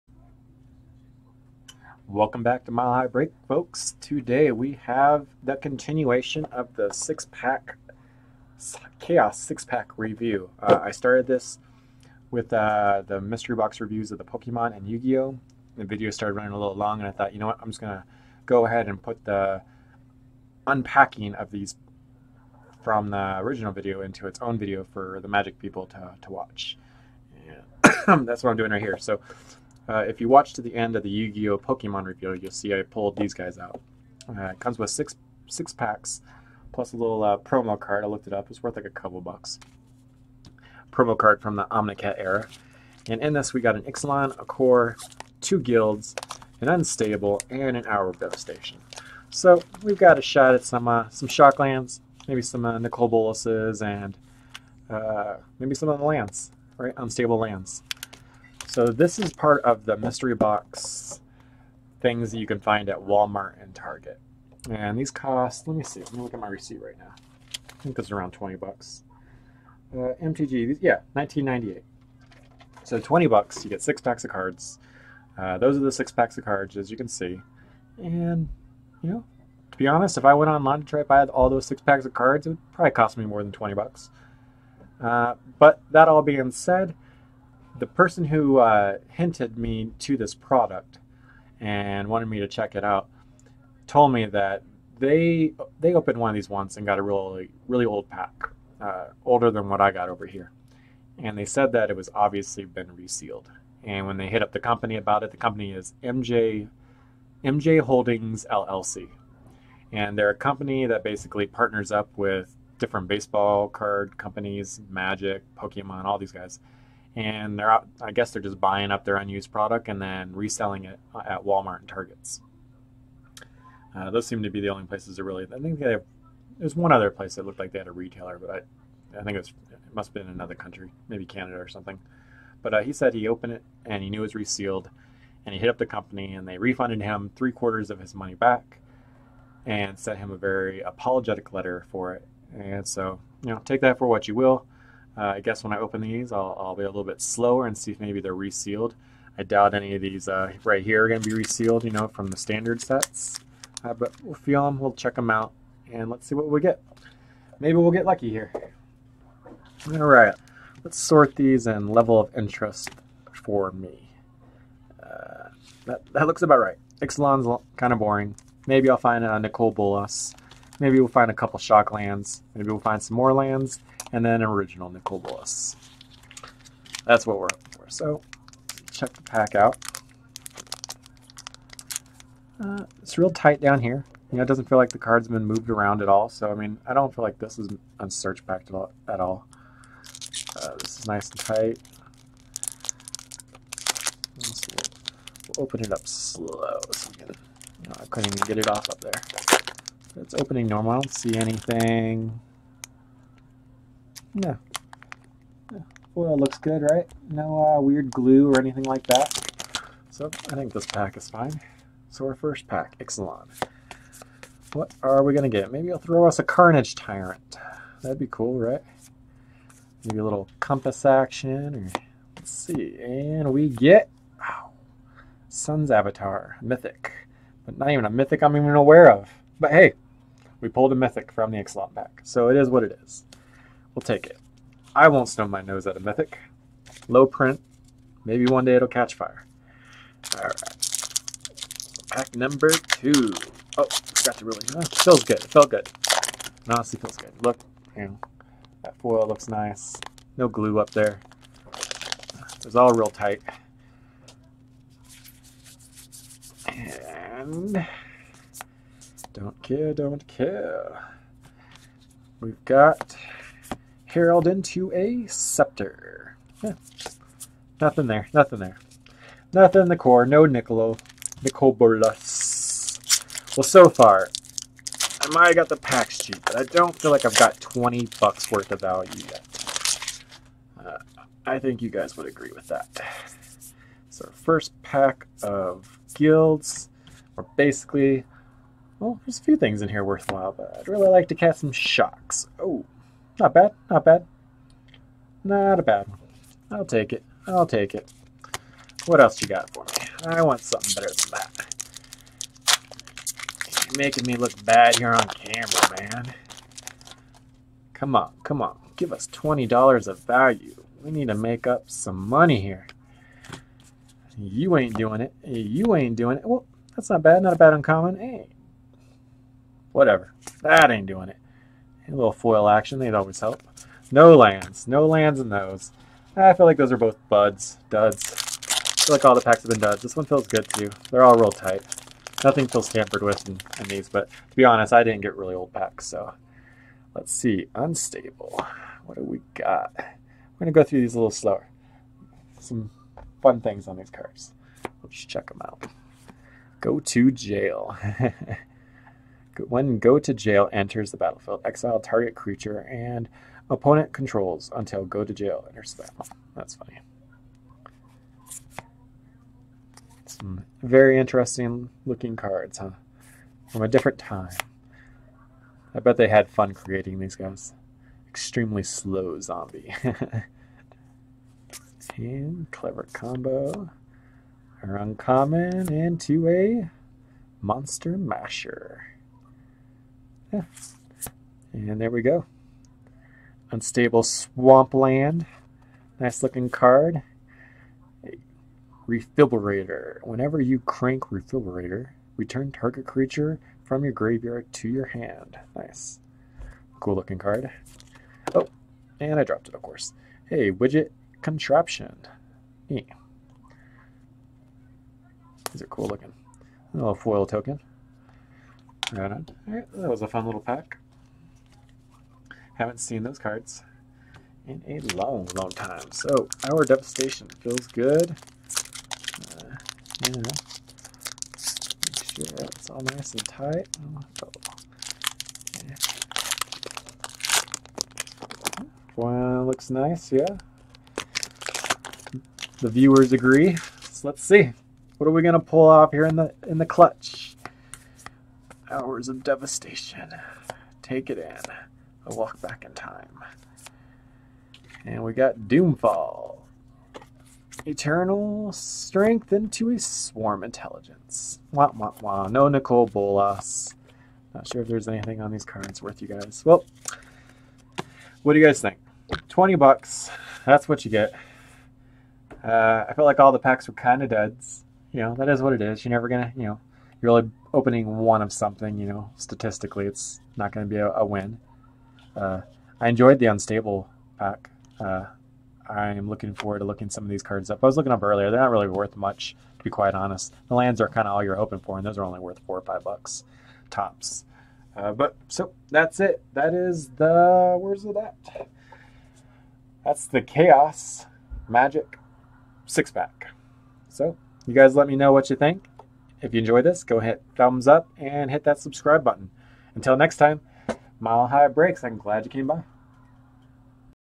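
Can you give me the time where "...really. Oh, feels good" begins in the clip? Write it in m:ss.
4:04.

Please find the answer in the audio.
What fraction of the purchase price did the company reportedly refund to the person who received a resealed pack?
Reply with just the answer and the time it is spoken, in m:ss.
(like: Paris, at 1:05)
three quarters, at 2:17.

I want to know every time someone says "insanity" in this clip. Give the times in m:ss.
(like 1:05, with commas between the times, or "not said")
not said.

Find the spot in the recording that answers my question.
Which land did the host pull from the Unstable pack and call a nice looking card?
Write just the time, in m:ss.
6:23.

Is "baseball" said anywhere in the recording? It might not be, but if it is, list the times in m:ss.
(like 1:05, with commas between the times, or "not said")
1:53.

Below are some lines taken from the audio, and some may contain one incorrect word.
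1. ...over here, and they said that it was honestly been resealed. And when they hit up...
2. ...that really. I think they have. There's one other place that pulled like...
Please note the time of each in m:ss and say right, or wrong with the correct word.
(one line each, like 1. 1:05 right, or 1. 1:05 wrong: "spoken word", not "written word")
1. 1:40 wrong: "obviously", not "honestly"
2. 2:05 wrong: "looked", not "pulled".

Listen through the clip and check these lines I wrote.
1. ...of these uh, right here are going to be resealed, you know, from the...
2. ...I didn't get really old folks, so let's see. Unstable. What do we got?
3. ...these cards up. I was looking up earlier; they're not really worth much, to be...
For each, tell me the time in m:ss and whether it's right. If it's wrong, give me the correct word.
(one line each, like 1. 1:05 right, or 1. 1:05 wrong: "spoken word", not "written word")
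1. 2:29 right
2. 5:34 wrong: "packs", not "folks"
3. 7:57 right.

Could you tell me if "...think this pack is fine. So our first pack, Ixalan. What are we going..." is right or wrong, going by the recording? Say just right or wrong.
right.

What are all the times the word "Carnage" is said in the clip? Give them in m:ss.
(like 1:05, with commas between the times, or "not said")
3:36.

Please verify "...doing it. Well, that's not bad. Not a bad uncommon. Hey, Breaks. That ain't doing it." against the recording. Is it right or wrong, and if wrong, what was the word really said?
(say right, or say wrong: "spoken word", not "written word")
wrong: "Whatever", not "Breaks".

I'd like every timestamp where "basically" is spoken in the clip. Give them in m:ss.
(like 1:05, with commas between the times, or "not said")
1:51, 4:47.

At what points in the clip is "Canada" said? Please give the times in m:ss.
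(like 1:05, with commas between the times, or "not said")
2:11.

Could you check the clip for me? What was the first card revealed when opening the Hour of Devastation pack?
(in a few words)
Doomfall.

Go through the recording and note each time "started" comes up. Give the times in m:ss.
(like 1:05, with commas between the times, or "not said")
0:10, 0:16.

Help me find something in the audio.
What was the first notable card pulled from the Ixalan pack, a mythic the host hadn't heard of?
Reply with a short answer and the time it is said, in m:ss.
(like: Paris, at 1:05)
Sun's Avatar, at 3:45.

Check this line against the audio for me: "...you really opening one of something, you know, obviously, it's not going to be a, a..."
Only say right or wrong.
wrong.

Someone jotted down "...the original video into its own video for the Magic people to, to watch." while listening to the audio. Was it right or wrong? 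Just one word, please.
right.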